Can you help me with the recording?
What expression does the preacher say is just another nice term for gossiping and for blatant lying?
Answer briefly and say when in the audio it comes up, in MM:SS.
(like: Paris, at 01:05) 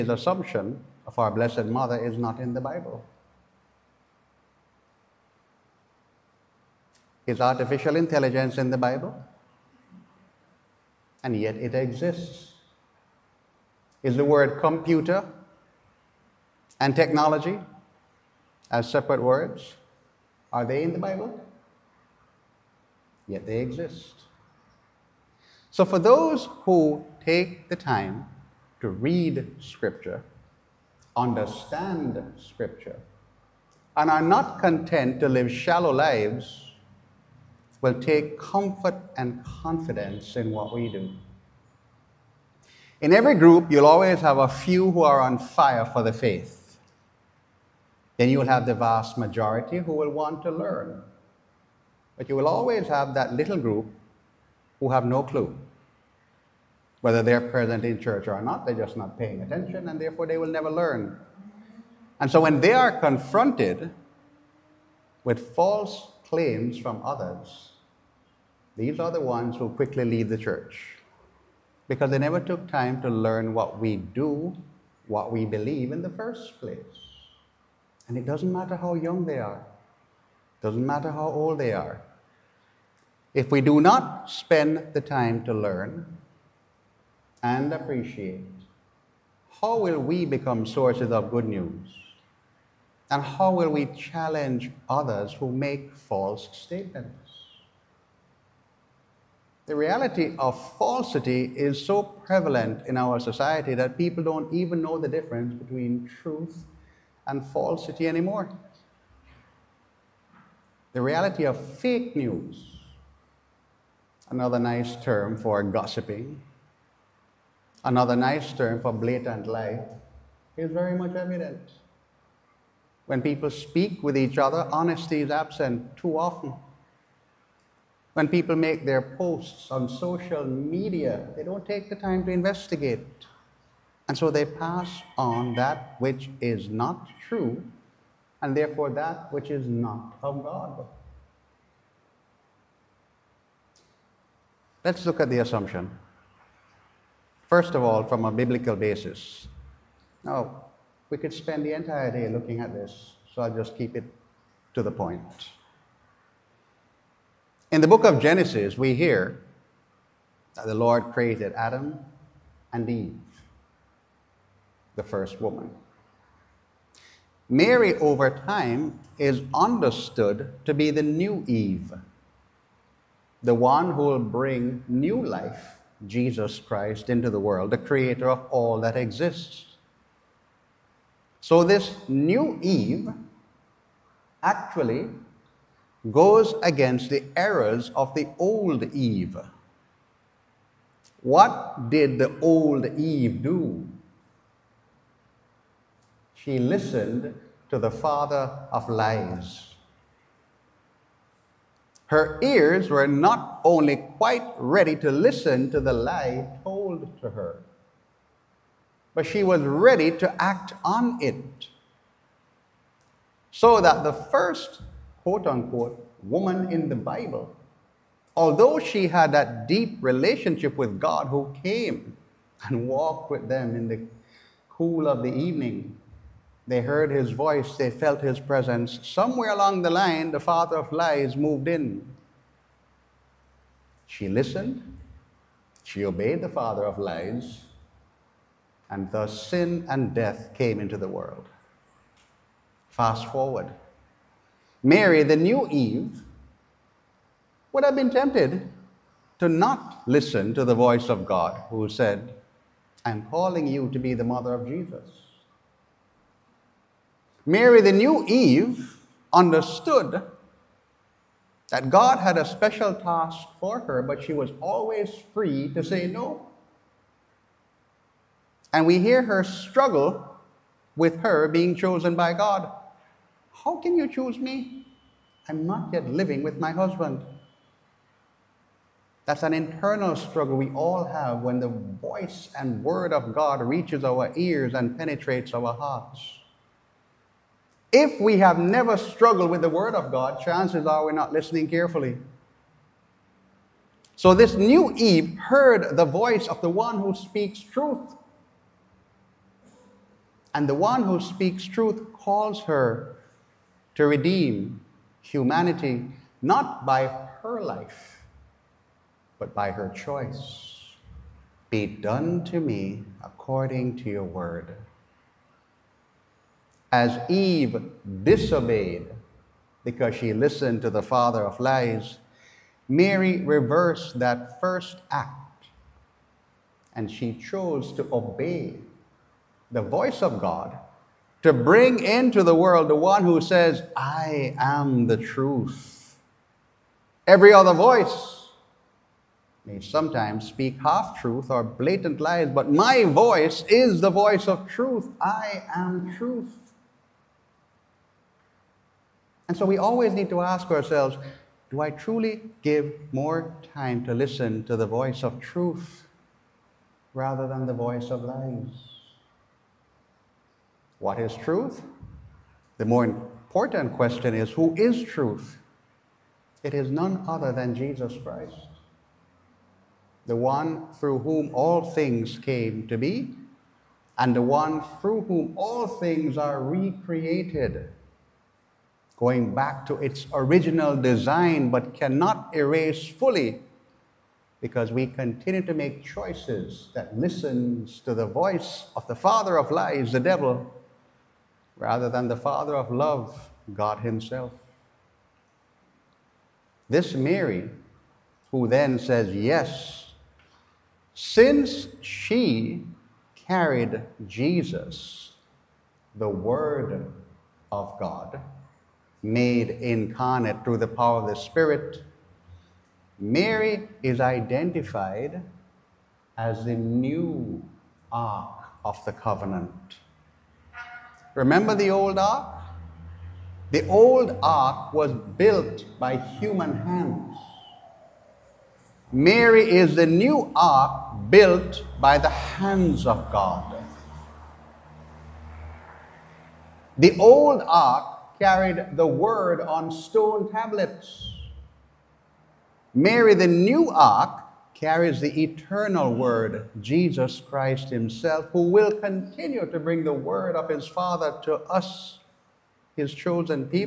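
Fake news, at 01:51.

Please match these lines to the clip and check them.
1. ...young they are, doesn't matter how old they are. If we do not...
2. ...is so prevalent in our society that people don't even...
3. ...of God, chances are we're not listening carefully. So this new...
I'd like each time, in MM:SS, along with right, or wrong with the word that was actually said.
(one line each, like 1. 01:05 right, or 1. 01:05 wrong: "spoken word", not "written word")
1. 01:18 right
2. 01:41 right
3. 04:49 right.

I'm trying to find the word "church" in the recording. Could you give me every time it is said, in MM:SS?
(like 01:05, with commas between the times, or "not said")
00:57, 01:10.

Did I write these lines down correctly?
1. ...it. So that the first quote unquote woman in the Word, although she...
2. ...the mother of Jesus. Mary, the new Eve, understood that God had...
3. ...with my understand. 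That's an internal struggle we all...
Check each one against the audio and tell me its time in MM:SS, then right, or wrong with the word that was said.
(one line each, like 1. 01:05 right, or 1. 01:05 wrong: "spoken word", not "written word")
1. 03:31 wrong: "Bible", not "Word"
2. 04:14 right
3. 04:36 wrong: "husband", not "understand".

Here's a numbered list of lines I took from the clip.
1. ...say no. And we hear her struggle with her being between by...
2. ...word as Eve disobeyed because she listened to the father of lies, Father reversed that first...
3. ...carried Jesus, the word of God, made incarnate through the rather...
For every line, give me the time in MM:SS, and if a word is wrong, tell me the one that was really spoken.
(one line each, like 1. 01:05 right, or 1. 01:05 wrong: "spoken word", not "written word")
1. 04:25 wrong: "chosen", not "between"
2. 05:14 wrong: "Mary", not "Father"
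3. 06:43 wrong: "power", not "rather".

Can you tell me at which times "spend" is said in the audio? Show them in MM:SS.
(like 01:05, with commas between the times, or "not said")
01:24, 02:31.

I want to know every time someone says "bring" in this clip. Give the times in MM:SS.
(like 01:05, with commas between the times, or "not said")
02:54, 05:31, 07:29.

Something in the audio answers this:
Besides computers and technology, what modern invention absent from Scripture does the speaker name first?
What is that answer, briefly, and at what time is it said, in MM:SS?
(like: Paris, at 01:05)
Artificial intelligence, at 00:07.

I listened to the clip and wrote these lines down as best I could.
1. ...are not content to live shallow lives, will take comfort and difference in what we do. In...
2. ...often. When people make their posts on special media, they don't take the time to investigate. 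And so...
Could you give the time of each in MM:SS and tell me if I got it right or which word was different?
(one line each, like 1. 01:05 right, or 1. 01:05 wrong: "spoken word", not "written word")
1. 00:34 wrong: "confidence", not "difference"
2. 02:06 wrong: "social", not "special".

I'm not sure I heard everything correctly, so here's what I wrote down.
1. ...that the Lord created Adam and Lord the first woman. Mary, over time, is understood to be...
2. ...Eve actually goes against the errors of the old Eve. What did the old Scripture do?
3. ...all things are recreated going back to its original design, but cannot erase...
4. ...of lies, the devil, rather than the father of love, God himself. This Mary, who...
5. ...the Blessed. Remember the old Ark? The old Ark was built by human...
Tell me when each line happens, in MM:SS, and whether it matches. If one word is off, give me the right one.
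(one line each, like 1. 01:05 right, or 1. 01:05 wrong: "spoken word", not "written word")
1. 02:40 wrong: "Eve", not "Lord"
2. 03:02 wrong: "Eve", not "Scripture"
3. 06:15 right
4. 06:29 right
5. 06:59 wrong: "Covenant", not "Blessed".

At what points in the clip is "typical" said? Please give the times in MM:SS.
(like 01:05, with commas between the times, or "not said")
not said.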